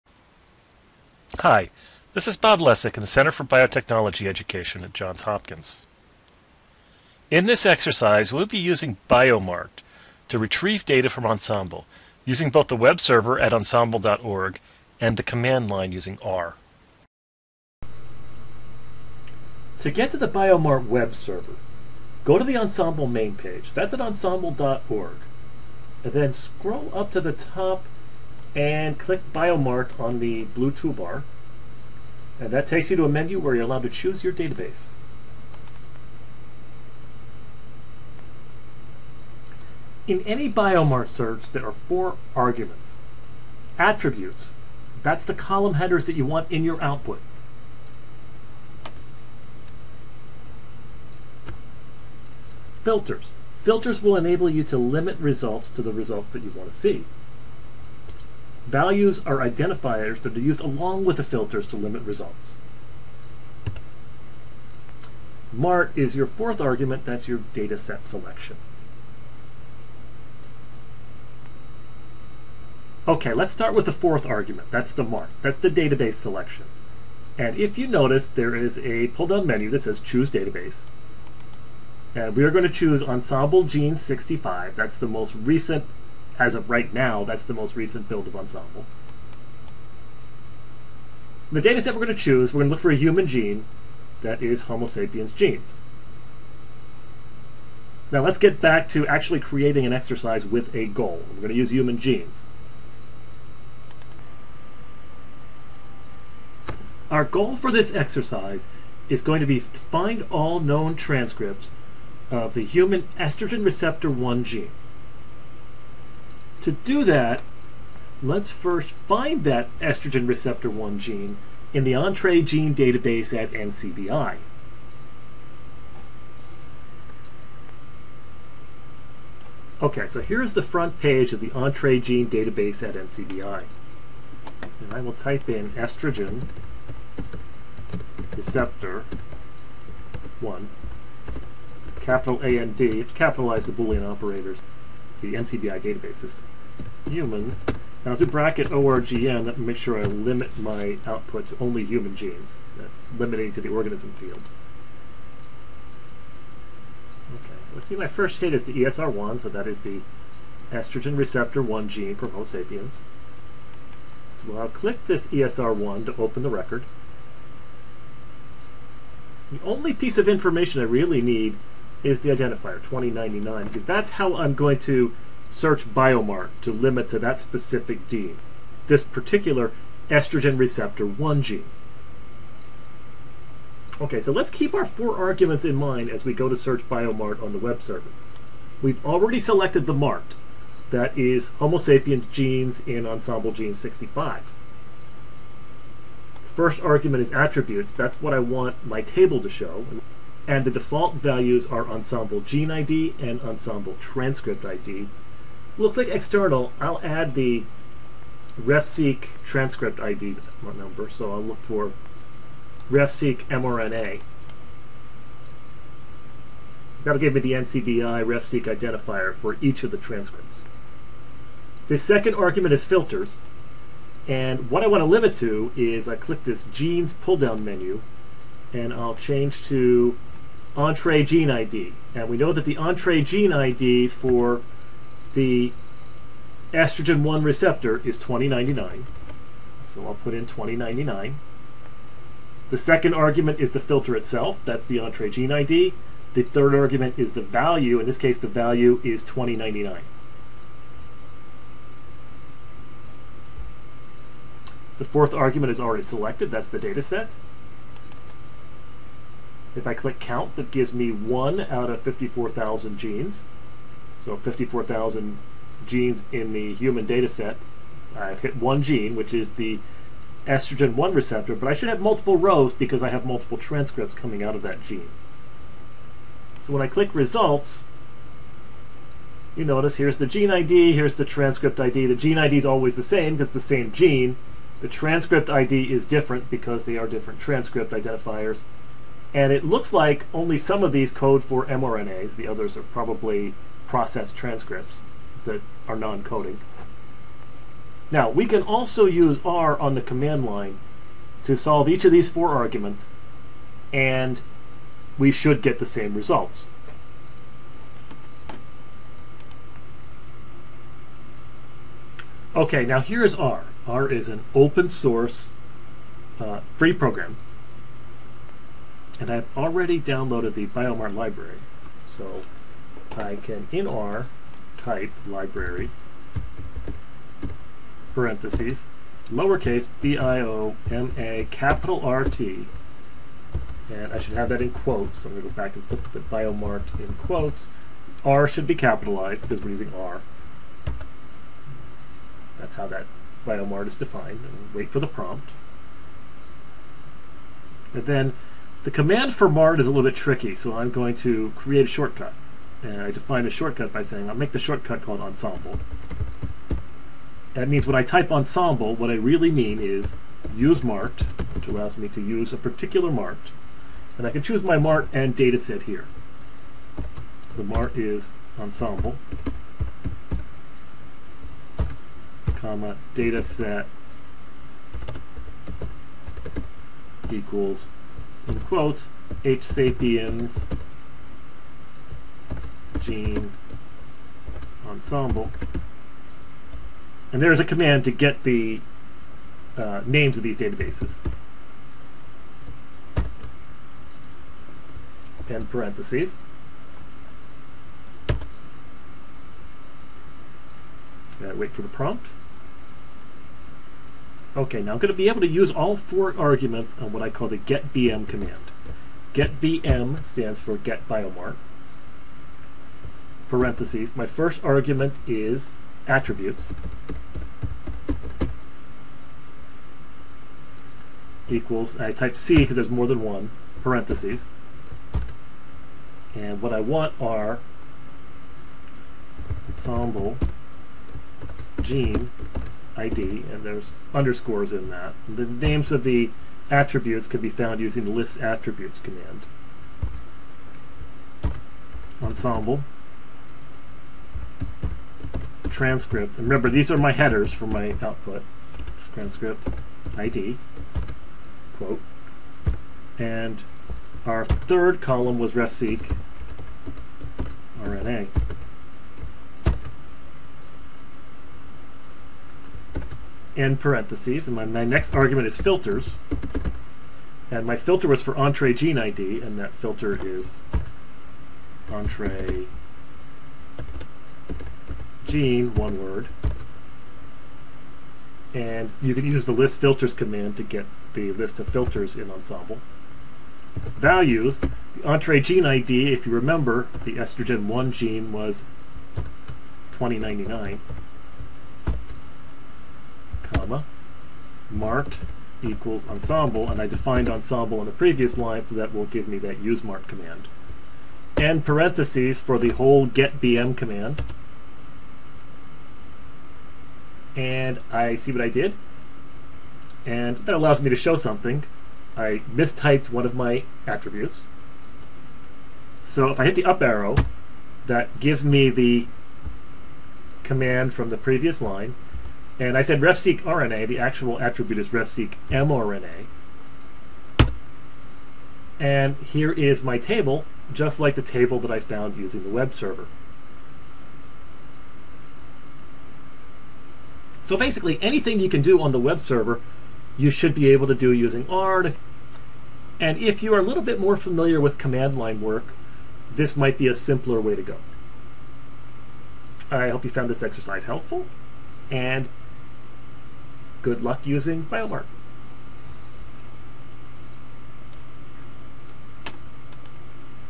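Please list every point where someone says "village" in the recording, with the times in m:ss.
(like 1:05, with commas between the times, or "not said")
not said.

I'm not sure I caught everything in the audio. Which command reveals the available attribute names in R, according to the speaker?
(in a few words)
list attributes.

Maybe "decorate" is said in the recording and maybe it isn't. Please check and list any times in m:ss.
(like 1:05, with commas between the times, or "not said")
not said.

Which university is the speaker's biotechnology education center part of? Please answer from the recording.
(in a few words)
Johns Hopkins.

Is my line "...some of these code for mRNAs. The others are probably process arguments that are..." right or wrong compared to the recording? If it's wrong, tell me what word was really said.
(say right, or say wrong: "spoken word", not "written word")
wrong: "transcripts", not "arguments".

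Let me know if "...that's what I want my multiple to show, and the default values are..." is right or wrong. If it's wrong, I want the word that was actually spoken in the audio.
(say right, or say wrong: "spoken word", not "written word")
wrong: "table", not "multiple".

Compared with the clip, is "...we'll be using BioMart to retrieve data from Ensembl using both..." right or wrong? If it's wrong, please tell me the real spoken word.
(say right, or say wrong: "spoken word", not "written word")
right.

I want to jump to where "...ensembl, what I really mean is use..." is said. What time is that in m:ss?
5:58.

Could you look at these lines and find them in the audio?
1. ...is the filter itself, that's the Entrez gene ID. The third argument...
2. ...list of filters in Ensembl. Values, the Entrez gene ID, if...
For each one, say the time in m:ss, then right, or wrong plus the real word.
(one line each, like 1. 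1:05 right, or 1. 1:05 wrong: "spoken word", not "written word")
1. 4:03 right
2. 8:01 right.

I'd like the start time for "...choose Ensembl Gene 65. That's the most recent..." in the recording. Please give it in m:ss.
1:22.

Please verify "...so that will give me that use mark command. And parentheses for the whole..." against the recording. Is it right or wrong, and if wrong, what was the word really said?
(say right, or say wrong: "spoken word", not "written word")
right.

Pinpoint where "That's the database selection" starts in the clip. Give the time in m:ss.
1:15.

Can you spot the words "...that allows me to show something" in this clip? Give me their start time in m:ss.
8:30.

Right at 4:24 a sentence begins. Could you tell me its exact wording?
So 54,000 genes in the human data set.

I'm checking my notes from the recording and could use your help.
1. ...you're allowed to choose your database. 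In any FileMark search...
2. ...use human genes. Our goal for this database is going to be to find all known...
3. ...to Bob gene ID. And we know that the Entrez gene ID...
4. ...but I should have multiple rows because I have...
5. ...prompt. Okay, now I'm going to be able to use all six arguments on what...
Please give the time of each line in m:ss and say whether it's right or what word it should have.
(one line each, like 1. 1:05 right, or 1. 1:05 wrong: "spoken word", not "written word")
1. 0:33 wrong: "Biomart", not "FileMark"
2. 1:41 wrong: "exercise", not "database"
3. 3:49 wrong: "Entrez", not "Bob"
4. 4:31 right
5. 6:41 wrong: "four", not "six".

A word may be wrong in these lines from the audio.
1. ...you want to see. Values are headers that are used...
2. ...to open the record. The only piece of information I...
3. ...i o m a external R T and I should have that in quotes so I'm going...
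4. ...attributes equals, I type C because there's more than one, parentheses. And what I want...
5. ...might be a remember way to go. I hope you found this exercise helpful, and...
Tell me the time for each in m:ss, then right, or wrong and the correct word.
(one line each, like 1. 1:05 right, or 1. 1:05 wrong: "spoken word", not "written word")
1. 0:56 wrong: "identifiers", not "headers"
2. 2:46 right
3. 5:30 wrong: "capital", not "external"
4. 6:56 right
5. 9:06 wrong: "simpler", not "remember".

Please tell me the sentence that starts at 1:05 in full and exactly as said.
MART is your fourth argument, that's your data set selection.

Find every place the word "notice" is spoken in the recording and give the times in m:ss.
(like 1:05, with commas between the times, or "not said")
1:17, 4:39.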